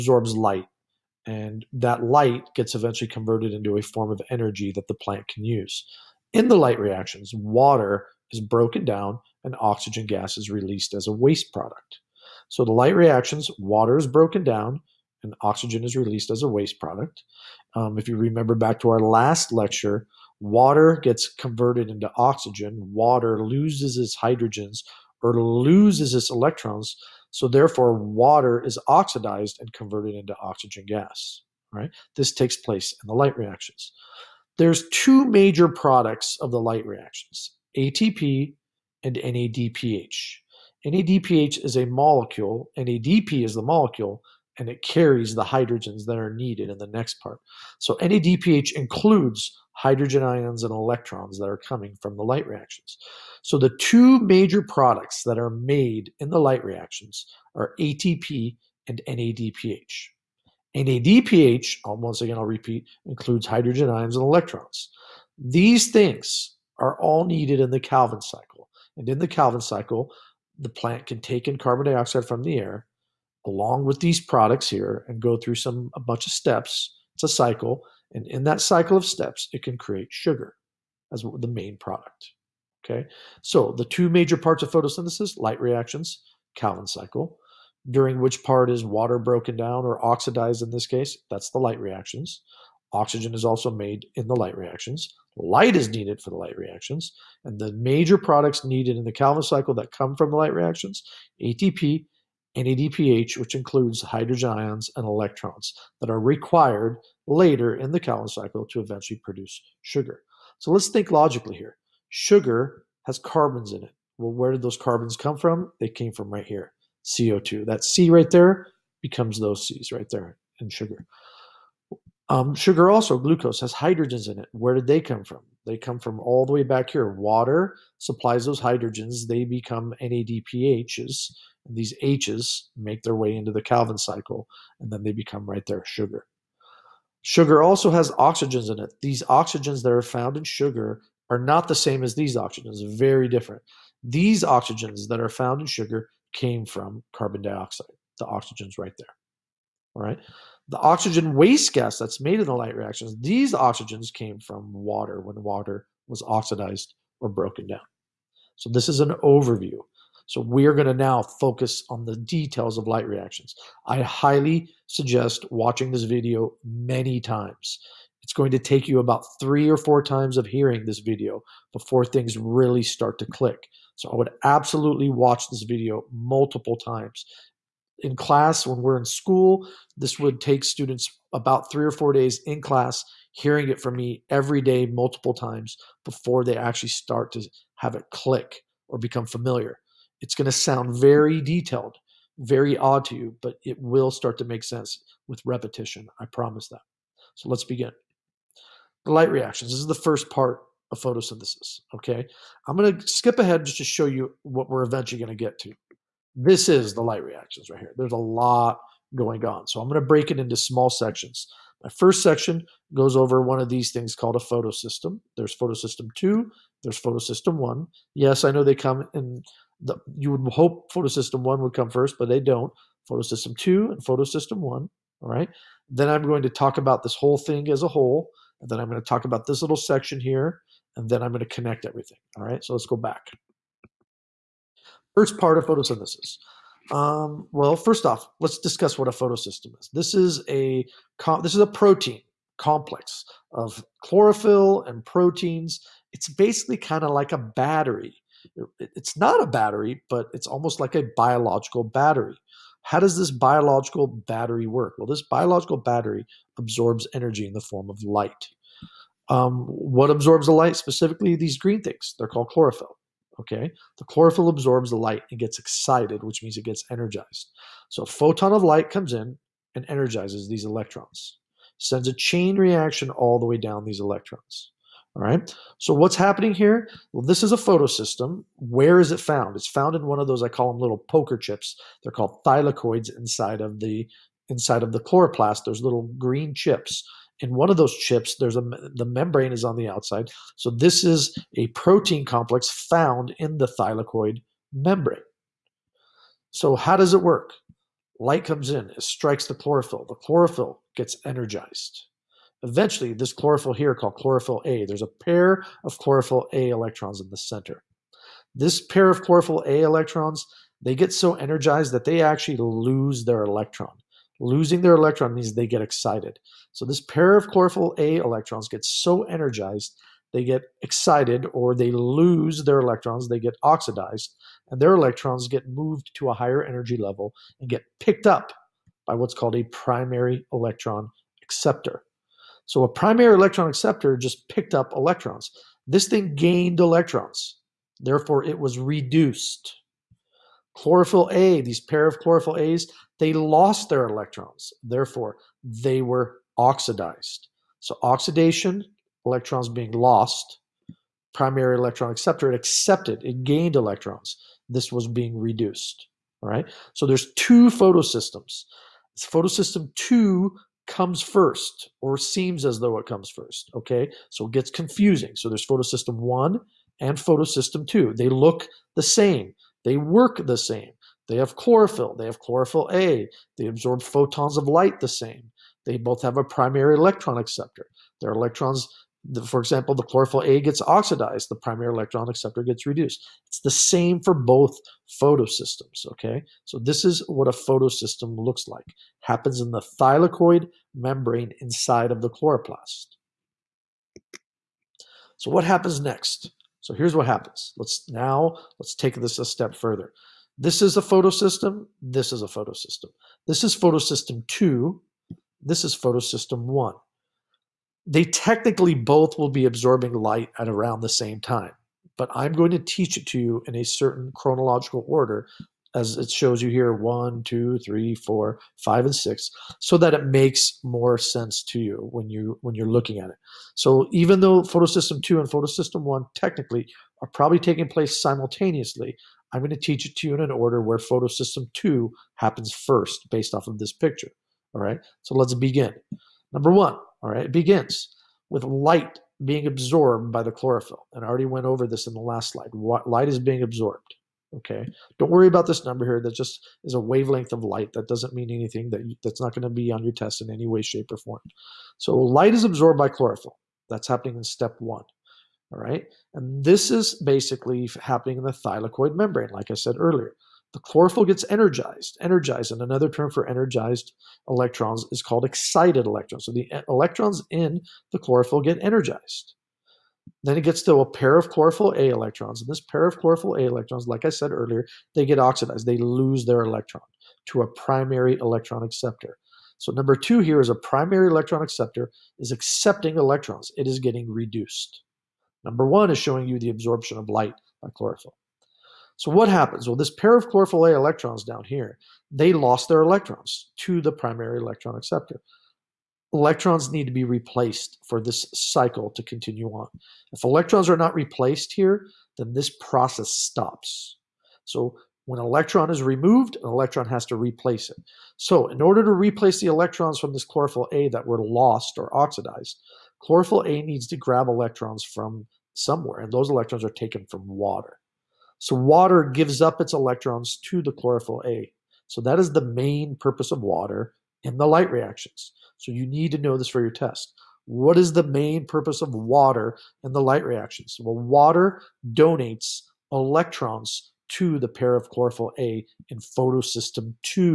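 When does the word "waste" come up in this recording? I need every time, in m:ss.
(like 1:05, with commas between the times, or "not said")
0:11, 0:16, 2:31.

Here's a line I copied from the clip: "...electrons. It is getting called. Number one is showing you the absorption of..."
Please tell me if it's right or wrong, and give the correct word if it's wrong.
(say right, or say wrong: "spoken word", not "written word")
wrong: "reduced", not "called".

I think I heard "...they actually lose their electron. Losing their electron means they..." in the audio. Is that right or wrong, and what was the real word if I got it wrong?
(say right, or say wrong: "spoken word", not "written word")
right.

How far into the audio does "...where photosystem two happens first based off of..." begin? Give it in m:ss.
7:10.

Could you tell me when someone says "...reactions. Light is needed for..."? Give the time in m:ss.
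1:34.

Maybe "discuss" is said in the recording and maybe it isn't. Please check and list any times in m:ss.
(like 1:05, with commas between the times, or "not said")
3:58.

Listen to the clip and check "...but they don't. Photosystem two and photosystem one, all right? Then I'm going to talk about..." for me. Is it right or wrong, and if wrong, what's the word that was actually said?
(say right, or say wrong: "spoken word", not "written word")
right.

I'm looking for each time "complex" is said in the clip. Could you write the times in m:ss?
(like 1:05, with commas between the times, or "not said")
4:02, 4:52.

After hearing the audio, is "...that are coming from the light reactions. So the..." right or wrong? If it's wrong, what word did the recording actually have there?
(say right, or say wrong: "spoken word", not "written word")
right.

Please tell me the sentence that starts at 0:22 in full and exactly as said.
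Water loses its hydrogens or loses its electrons.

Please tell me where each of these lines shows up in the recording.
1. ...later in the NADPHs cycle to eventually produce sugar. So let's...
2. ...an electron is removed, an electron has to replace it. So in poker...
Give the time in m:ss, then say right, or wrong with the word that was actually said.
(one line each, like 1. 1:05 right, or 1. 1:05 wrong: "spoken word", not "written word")
1. 1:47 wrong: "Calvin", not "NADPHs"
2. 8:25 wrong: "order", not "poker".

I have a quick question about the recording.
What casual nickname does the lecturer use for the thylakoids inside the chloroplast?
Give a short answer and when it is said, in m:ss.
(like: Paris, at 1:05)
Poker chips, at 4:40.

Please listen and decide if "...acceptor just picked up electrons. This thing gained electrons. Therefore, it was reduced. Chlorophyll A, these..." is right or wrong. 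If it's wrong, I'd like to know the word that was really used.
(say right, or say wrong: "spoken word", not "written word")
right.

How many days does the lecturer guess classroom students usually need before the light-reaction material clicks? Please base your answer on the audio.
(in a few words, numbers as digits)
3 or 4 days.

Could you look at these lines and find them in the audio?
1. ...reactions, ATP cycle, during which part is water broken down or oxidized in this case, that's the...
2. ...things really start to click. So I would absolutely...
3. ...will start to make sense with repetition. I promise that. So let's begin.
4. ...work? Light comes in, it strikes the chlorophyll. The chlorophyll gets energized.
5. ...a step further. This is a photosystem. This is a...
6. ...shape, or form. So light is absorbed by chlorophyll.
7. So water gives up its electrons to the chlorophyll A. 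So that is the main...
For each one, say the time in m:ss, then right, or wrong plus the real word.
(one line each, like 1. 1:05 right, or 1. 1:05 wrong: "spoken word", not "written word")
1. 1:25 wrong: "Calvin", not "ATP"
2. 2:52 right
3. 3:13 right
4. 4:57 right
5. 6:39 right
6. 7:30 right
7. 8:38 right.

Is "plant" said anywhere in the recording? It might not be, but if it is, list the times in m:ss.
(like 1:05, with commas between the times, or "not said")
0:04, 1:10.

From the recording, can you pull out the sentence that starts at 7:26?
That just is a wavelength of light.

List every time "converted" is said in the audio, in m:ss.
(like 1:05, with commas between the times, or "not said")
0:03, 0:21, 0:29.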